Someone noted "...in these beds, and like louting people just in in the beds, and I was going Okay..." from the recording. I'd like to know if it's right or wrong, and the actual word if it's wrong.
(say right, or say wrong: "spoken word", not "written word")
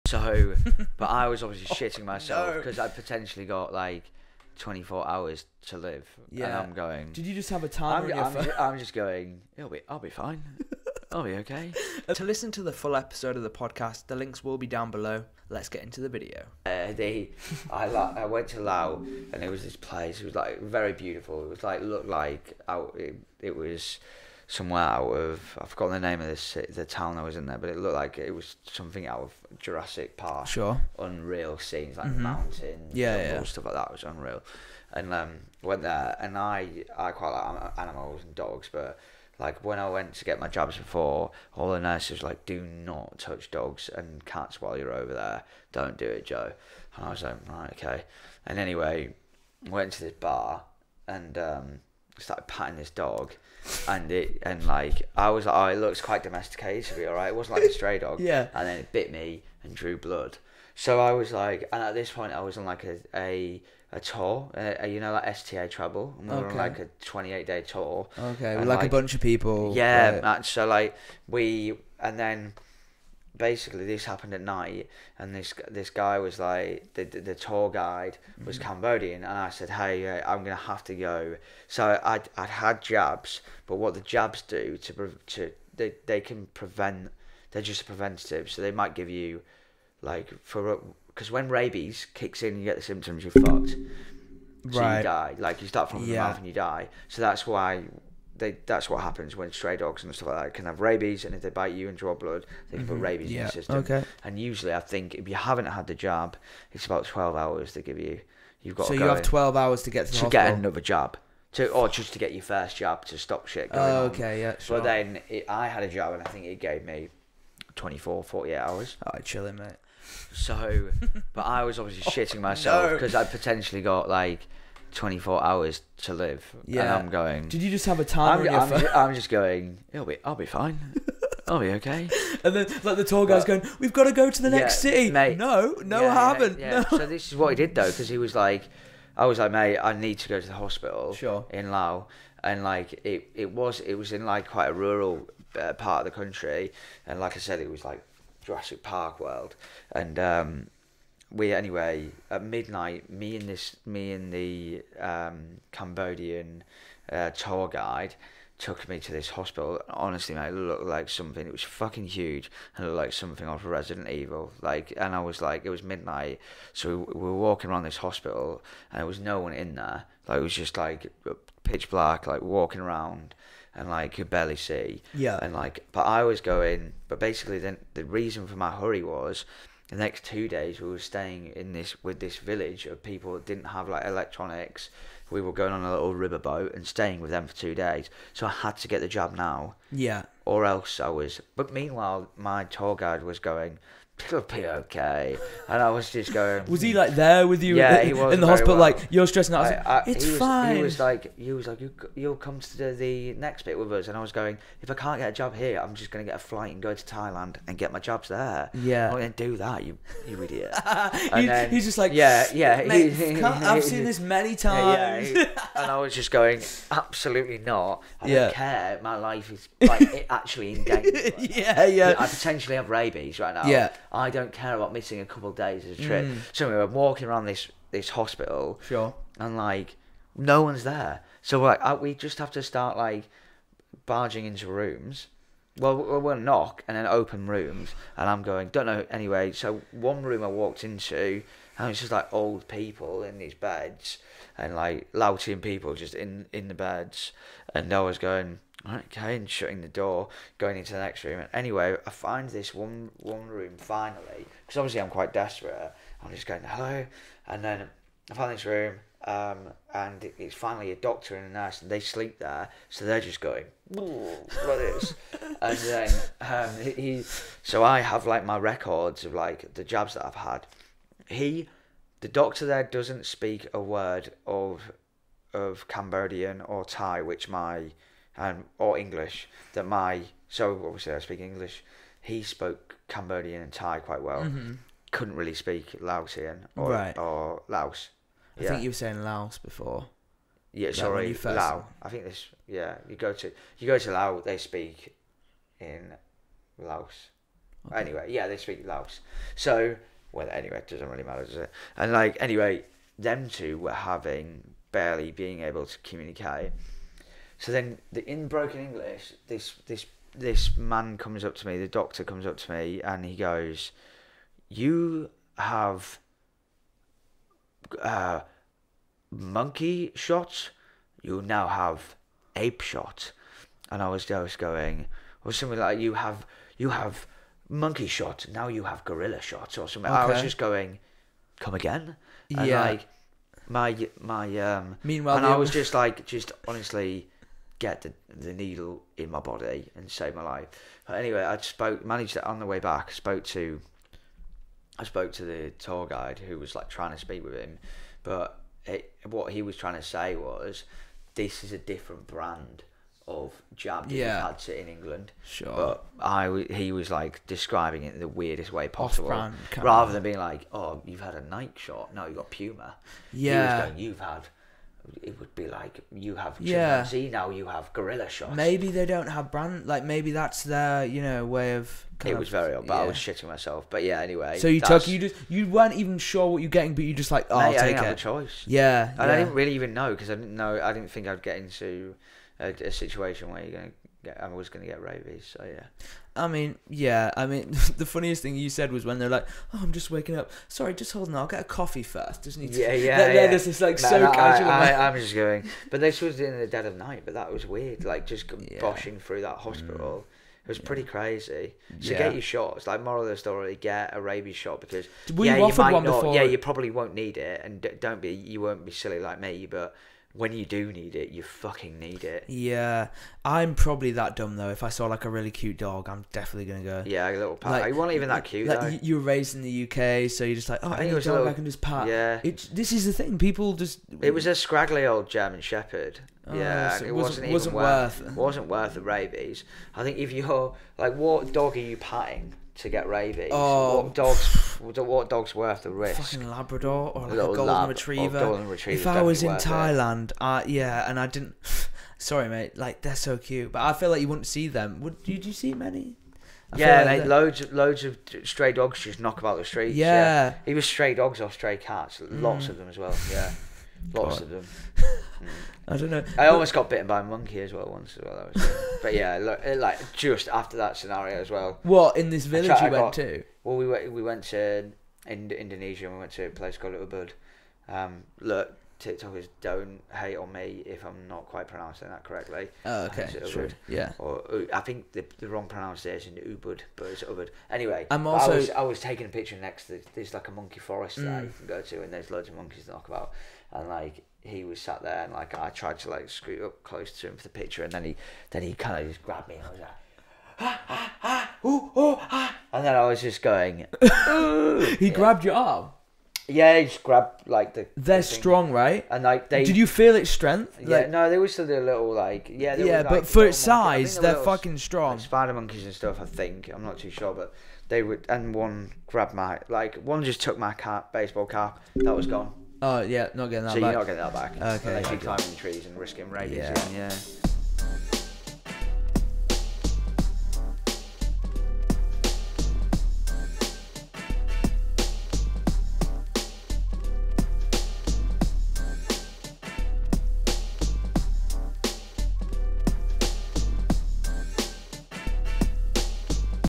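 right.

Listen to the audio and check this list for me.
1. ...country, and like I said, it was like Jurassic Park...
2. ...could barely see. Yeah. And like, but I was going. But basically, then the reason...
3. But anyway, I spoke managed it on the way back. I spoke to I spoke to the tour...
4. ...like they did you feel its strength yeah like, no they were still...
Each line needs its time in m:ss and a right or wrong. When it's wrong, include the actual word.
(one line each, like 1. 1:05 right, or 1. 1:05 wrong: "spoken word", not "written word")
1. 2:26 right
2. 2:54 right
3. 5:41 right
4. 8:19 right.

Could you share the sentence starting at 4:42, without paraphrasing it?
He spoke Cambodian and Thai quite well.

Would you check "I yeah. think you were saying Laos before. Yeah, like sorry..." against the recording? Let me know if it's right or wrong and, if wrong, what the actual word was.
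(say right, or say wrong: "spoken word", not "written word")
right.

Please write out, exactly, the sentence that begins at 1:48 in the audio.
You've got so you have twelve hours to get to, to get another jab.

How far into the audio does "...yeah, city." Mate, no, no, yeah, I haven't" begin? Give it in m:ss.
2:14.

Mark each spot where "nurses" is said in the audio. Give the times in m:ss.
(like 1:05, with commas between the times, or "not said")
0:41, 4:21.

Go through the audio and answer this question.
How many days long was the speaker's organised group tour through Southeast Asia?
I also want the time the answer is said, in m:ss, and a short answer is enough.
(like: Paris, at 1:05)
28, at 1:07.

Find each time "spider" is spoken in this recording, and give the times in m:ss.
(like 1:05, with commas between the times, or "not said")
8:25.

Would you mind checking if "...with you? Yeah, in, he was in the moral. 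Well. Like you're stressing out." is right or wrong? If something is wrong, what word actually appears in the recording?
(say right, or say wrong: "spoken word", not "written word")
wrong: "hospital", not "moral".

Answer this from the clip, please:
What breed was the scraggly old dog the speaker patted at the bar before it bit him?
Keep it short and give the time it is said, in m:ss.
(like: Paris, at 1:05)
German Shepherd, at 7:05.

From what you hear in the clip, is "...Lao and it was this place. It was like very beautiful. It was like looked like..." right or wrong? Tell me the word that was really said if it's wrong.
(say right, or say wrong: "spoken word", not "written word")
right.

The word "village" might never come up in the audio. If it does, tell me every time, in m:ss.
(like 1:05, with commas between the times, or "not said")
3:02, 7:42.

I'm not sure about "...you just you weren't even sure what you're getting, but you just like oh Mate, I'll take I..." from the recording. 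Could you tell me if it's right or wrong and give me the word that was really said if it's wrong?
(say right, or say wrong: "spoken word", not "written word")
right.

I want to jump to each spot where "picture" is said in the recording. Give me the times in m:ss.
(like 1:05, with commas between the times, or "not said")
7:59, 8:07.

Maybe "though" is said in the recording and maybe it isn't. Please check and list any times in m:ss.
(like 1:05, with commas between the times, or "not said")
2:17, 6:54.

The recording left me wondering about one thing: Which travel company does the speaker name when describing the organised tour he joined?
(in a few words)
STA Travel.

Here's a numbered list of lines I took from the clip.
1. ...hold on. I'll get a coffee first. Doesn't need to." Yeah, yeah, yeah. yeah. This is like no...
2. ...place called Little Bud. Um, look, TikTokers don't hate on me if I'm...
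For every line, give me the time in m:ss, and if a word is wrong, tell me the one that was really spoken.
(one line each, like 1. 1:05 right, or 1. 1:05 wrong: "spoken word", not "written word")
1. 6:31 right
2. 7:46 right.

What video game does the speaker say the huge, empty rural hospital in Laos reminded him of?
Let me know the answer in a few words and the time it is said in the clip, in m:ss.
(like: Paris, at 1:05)
Resident Evil, at 2:43.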